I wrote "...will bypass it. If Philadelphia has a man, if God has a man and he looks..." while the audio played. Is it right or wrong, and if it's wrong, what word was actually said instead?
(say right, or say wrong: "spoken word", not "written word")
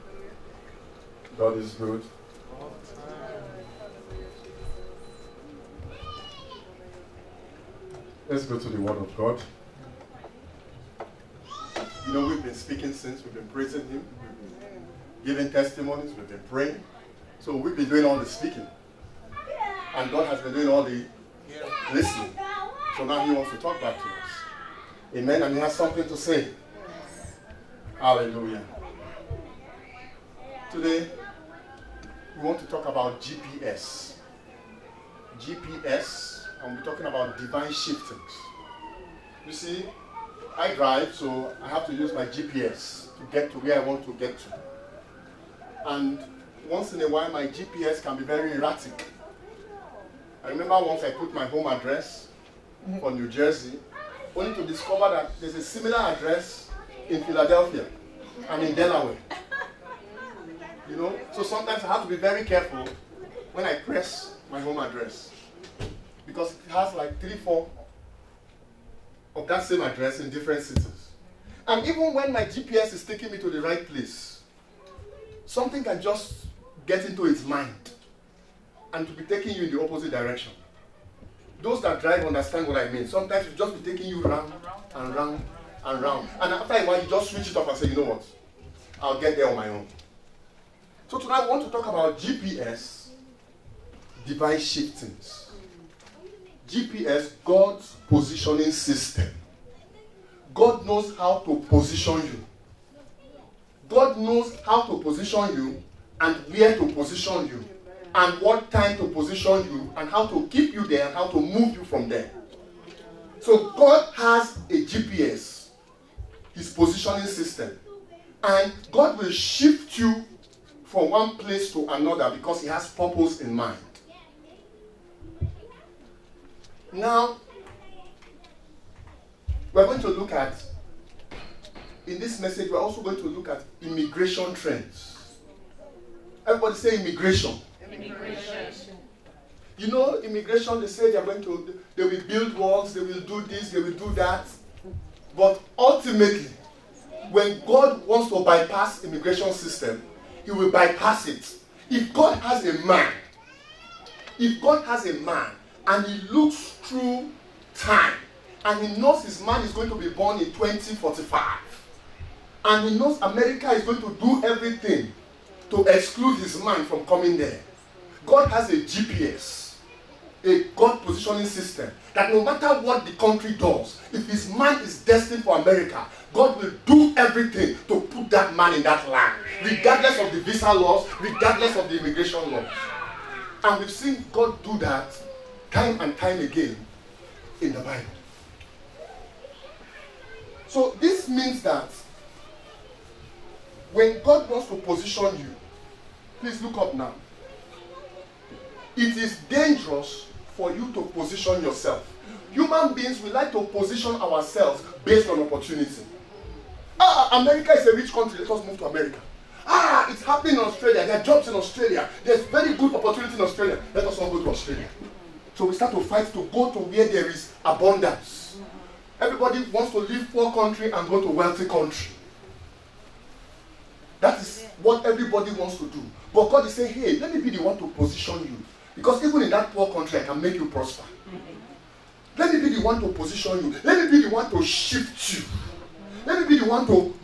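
wrong: "God", not "Philadelphia".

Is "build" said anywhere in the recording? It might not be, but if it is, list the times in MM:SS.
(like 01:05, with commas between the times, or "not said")
02:22.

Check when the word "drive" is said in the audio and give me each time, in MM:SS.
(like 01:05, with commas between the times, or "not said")
00:40, 01:22.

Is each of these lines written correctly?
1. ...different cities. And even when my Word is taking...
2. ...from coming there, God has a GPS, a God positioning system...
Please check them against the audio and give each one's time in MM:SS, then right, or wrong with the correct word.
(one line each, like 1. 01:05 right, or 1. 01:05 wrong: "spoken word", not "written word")
1. 01:10 wrong: "GPS", not "Word"
2. 02:46 right.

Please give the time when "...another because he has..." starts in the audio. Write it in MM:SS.
02:01.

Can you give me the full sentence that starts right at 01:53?
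So God has a GPS, his positioning system.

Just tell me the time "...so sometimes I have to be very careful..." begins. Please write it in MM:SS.
01:01.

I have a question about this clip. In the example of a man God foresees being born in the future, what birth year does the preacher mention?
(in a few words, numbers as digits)
2045.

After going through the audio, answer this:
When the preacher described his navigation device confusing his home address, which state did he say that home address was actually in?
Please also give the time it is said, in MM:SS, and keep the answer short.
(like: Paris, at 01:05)
New Jersey, at 00:53.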